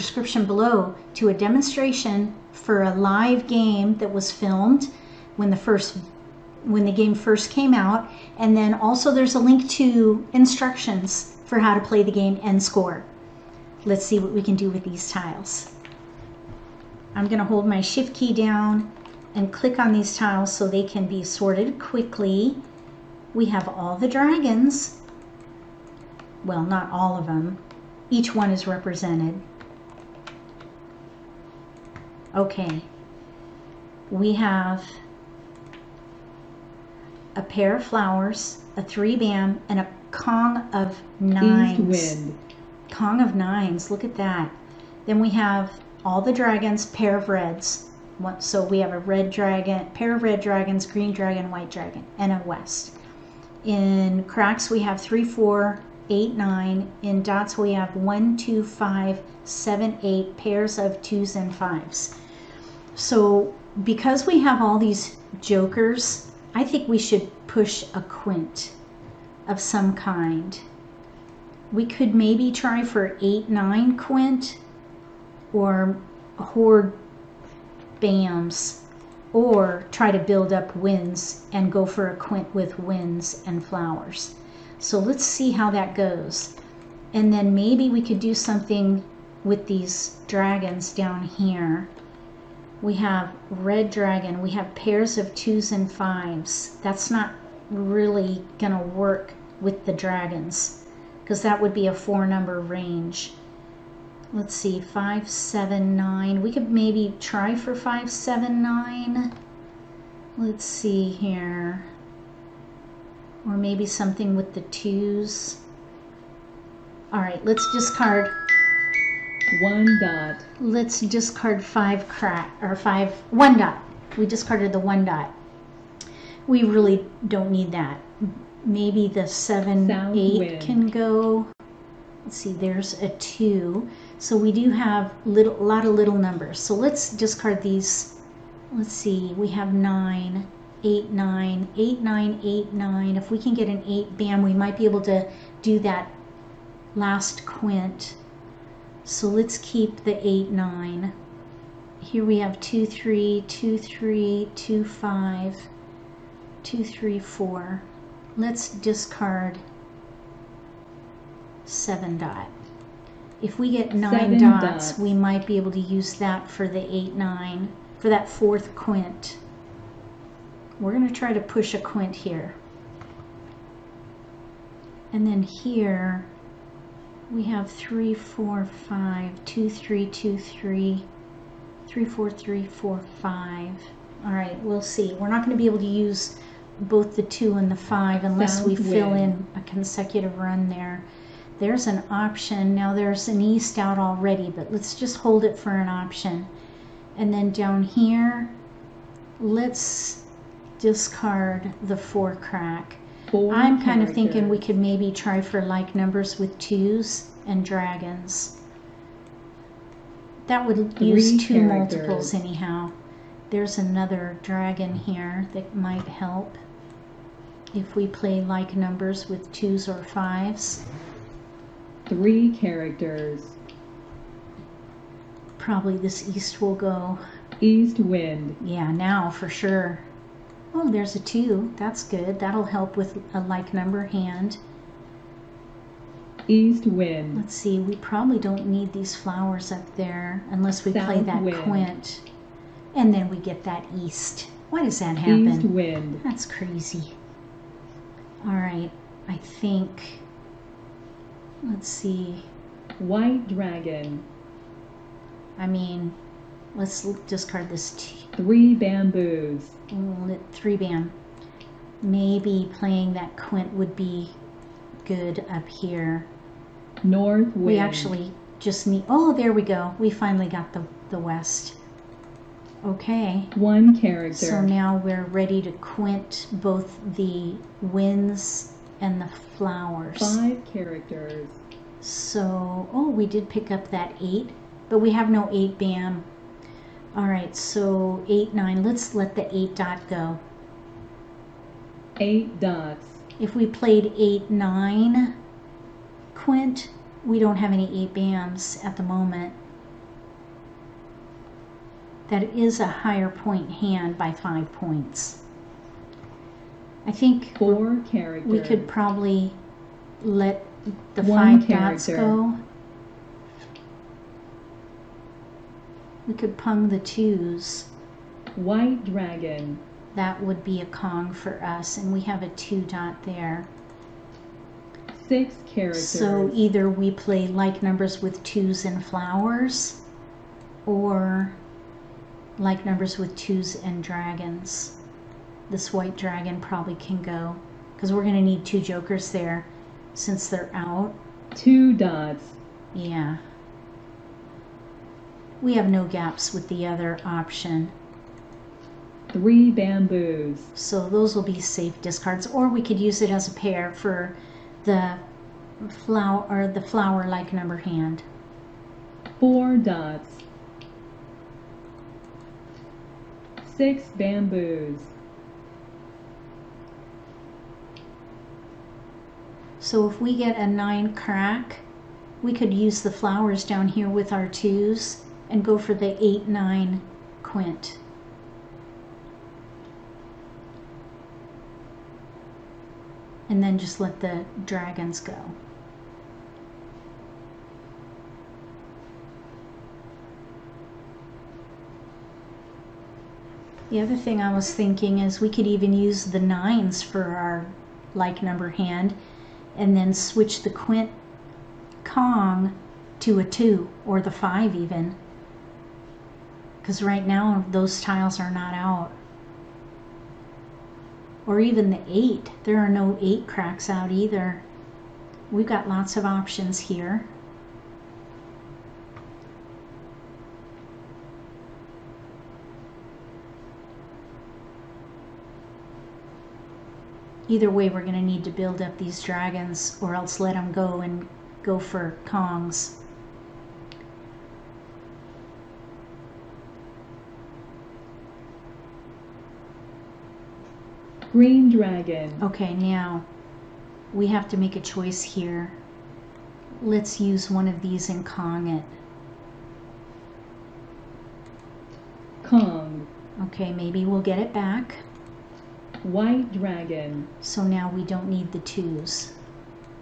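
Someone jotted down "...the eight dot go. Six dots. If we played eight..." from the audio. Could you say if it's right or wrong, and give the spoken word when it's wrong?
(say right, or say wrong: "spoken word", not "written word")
wrong: "Eight", not "Six".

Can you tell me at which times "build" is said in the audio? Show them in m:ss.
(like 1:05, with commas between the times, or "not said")
1:20, 7:08.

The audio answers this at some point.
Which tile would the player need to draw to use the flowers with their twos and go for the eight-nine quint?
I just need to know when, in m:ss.
6:10.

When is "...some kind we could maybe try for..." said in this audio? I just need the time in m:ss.
1:09.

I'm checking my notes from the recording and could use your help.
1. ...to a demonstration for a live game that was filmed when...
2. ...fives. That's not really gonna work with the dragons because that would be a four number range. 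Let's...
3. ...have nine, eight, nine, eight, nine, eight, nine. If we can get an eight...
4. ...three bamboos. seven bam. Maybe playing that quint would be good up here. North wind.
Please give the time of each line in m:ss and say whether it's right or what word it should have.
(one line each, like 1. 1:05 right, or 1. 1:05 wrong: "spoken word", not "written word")
1. 0:01 right
2. 1:35 right
3. 2:19 right
4. 4:18 wrong: "three", not "seven".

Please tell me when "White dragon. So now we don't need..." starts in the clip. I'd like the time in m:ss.
7:36.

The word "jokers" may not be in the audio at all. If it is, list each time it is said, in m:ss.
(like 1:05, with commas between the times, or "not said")
1:05, 5:38.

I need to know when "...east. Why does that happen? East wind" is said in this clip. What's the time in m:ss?
4:03.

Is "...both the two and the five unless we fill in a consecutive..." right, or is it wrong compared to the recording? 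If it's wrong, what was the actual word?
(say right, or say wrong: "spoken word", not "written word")
right.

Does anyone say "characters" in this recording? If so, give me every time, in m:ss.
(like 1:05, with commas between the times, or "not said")
3:31, 3:42, 4:33, 4:40, 5:11, 5:25.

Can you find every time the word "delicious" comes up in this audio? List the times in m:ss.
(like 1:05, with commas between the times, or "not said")
not said.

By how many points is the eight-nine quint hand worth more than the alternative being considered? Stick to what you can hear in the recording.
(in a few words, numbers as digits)
5.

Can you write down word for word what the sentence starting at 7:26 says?
Let's use one of these and Kong it.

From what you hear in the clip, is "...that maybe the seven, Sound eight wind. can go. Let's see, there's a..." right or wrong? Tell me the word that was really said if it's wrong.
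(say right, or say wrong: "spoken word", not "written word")
right.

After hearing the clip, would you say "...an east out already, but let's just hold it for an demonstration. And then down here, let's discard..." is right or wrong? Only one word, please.
wrong.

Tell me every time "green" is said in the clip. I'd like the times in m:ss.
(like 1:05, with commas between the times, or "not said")
0:50, 7:21.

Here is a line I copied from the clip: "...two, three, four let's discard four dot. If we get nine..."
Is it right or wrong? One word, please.
wrong.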